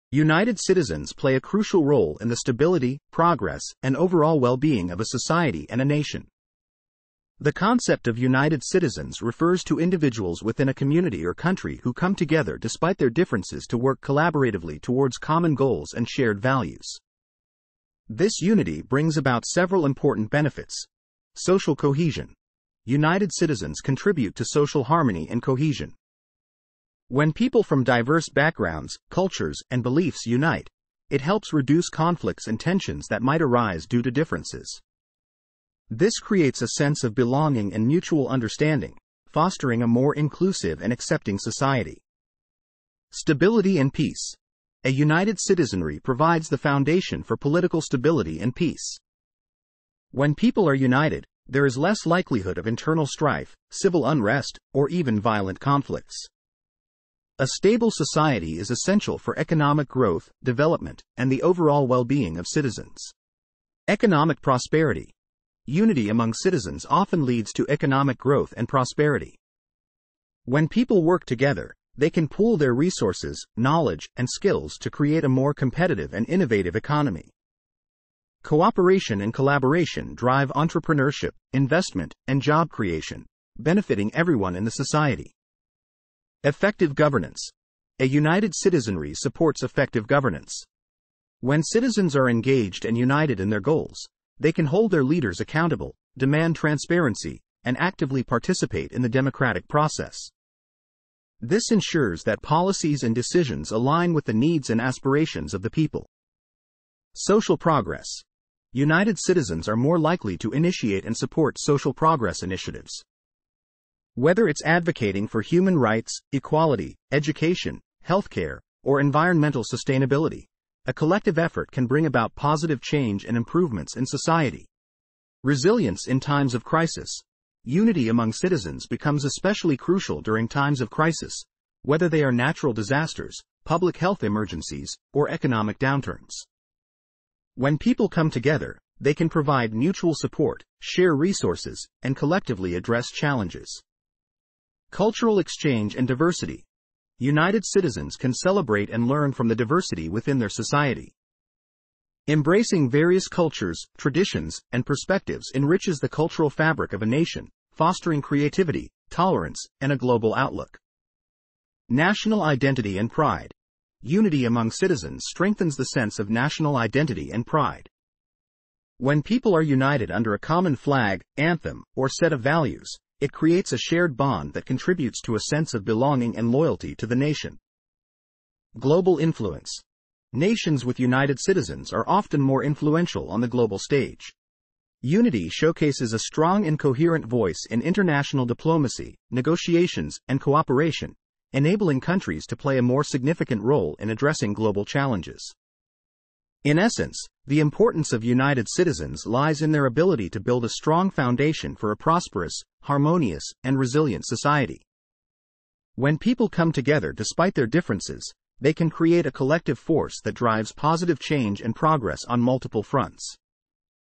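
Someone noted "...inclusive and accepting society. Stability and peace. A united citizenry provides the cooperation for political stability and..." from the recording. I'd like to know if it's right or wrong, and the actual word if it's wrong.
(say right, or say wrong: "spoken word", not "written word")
wrong: "foundation", not "cooperation".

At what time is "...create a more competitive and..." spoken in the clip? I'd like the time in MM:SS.
01:14.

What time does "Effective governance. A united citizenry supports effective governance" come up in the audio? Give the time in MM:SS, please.
01:26.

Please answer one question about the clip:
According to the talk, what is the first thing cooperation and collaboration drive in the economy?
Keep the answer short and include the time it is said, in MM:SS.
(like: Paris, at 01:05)
entrepreneurship, at 01:20.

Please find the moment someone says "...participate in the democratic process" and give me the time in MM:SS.
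01:38.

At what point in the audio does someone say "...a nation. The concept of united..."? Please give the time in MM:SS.
00:05.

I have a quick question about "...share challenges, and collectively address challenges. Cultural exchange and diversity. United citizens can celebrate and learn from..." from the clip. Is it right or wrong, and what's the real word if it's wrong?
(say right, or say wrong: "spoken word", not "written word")
wrong: "resources", not "challenges".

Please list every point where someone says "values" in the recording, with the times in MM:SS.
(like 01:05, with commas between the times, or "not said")
00:16, 02:52.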